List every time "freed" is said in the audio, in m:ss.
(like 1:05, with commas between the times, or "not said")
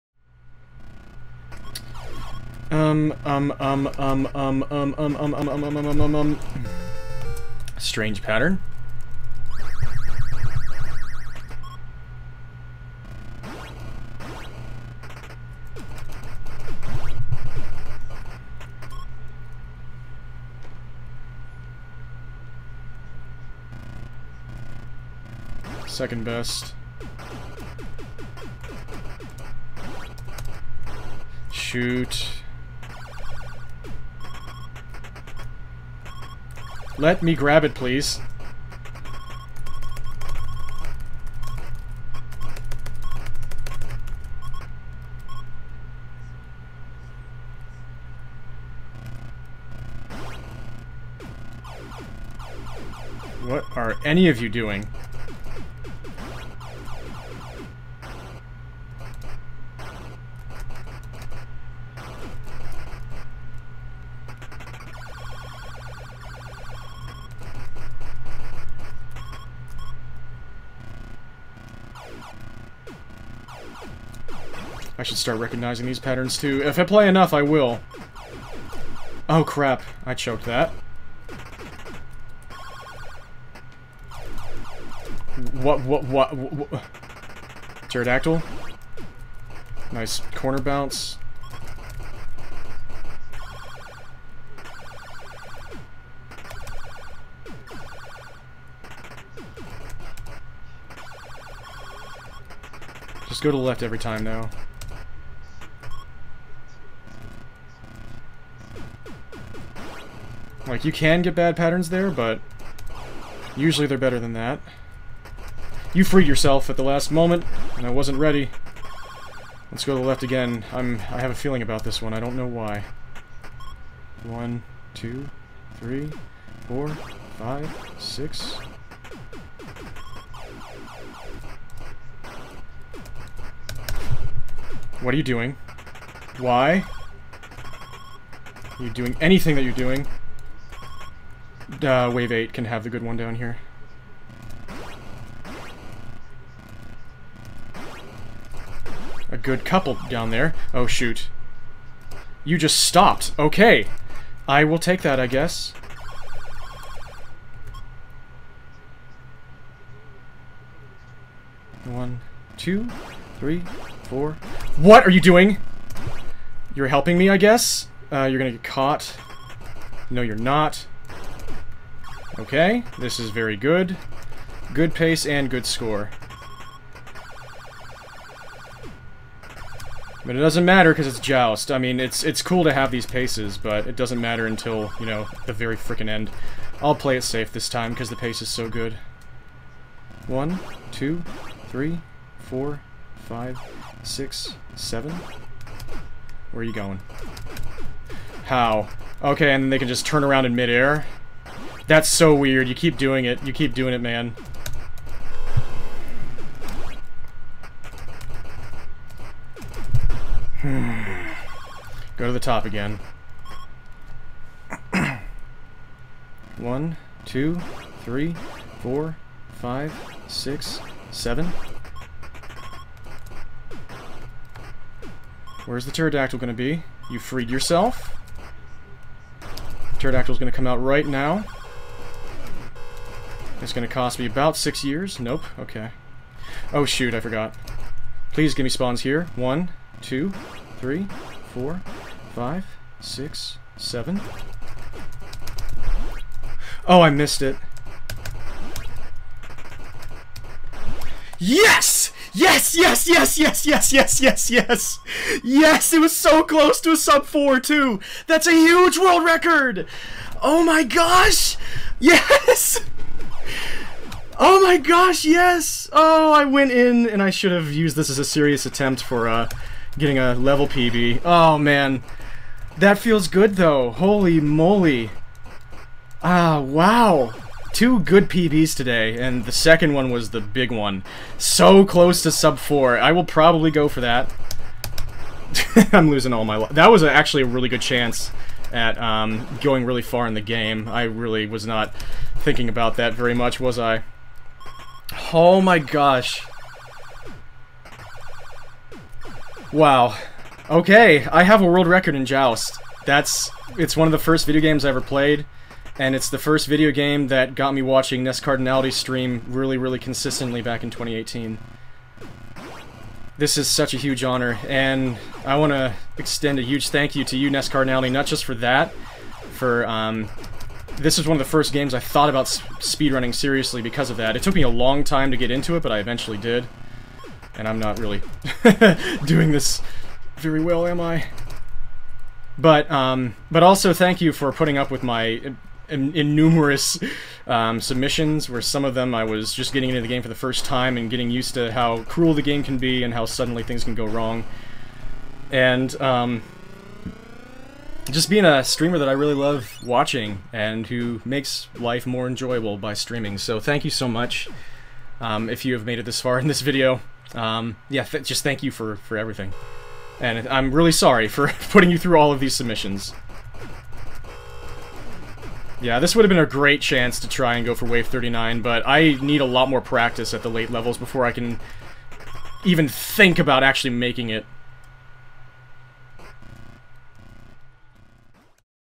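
1:56, 3:47.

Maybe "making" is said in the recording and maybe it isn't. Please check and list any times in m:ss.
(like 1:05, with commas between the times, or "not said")
6:13.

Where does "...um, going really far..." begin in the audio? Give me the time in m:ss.
4:48.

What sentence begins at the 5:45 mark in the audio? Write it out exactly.
And um, just being a streamer that I really love watching and who makes life more enjoyable by streaming.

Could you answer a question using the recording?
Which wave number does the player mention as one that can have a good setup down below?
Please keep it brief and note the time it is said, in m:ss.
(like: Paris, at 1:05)
8, at 2:22.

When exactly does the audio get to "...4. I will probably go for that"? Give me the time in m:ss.
4:42.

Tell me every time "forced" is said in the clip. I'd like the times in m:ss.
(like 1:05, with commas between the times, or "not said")
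not said.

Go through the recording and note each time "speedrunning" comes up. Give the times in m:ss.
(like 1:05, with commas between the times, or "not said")
5:22.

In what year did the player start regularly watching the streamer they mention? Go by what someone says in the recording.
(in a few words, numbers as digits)
2018.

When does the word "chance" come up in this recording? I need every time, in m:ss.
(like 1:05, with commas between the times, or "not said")
4:47, 6:06.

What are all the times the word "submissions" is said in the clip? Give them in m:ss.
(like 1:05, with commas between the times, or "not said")
5:37, 6:02.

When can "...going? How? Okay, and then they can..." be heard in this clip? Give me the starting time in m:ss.
3:16.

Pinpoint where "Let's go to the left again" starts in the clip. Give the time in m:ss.
1:59.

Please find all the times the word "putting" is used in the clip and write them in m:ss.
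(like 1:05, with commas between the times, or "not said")
5:34, 6:01.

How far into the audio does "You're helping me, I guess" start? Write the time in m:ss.
2:46.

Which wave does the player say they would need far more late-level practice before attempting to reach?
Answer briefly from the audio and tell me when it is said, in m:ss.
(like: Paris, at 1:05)
39, at 6:07.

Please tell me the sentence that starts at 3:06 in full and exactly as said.
I'll play it safe this time because the pace is so good.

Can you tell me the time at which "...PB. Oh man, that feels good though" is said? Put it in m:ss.
4:30.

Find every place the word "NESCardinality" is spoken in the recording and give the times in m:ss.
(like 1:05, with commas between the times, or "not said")
5:08, 5:17.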